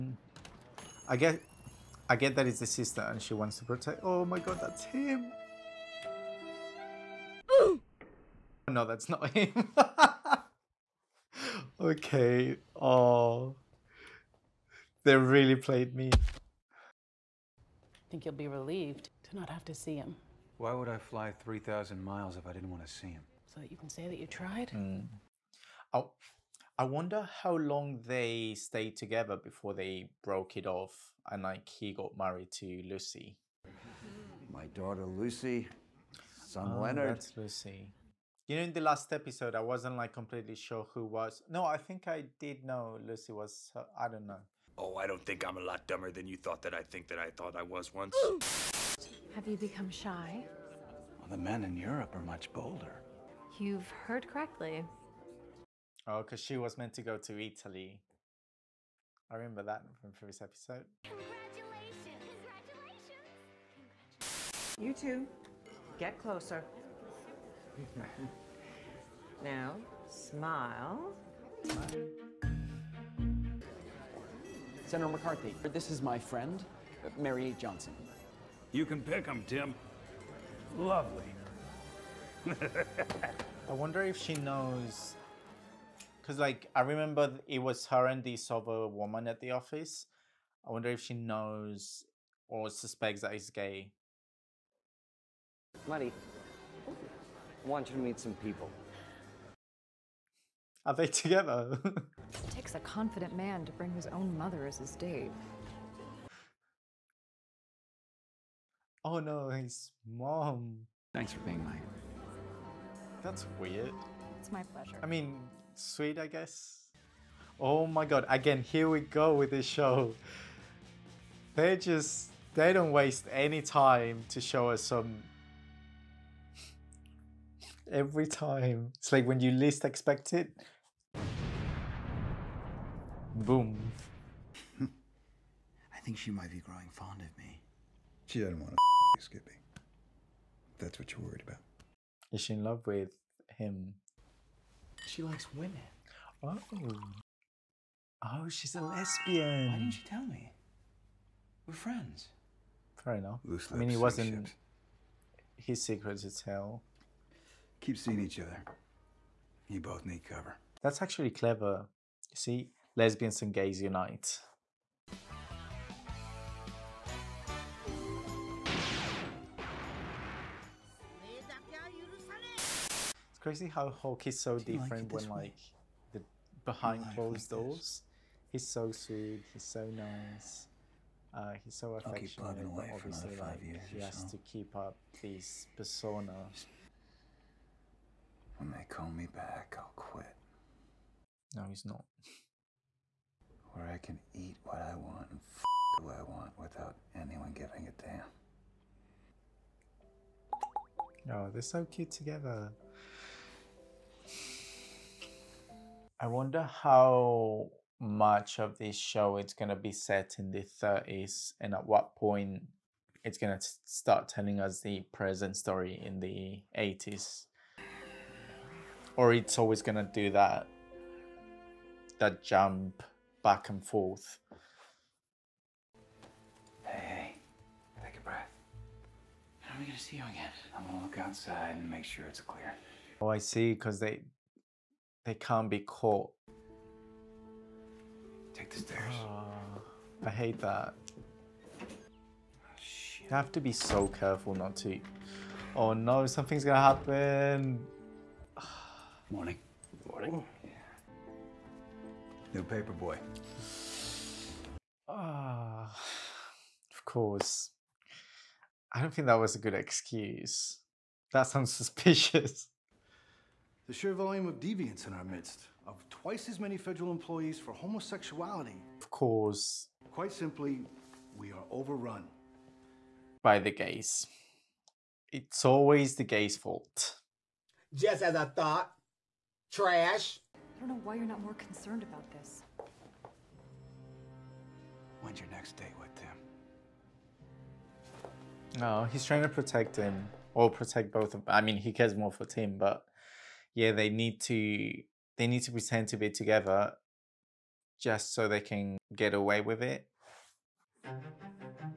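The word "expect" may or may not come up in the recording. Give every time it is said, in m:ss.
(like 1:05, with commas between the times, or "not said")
2:09.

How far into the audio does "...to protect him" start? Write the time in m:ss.
4:49.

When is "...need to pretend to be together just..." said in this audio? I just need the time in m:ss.
4:55.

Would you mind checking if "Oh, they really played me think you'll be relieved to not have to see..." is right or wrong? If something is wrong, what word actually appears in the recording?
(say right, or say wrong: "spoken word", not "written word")
right.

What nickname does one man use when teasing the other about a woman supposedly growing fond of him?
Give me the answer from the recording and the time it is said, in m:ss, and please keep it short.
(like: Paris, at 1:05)
Skippy, at 2:19.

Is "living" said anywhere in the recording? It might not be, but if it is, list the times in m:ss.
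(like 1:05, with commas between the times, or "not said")
not said.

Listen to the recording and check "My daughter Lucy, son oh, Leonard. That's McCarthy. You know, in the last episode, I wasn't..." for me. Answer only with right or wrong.
wrong.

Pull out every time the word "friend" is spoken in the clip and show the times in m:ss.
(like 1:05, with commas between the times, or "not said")
1:16, 2:31.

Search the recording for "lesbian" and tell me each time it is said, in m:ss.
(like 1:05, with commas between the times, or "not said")
2:28, 2:42.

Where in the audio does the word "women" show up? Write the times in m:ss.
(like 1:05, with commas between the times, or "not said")
2:25.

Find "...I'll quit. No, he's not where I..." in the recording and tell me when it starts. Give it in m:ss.
3:09.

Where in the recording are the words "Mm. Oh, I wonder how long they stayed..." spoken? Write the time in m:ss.
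0:24.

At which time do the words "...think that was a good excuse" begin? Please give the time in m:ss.
4:19.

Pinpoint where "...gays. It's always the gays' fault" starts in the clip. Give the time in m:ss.
4:33.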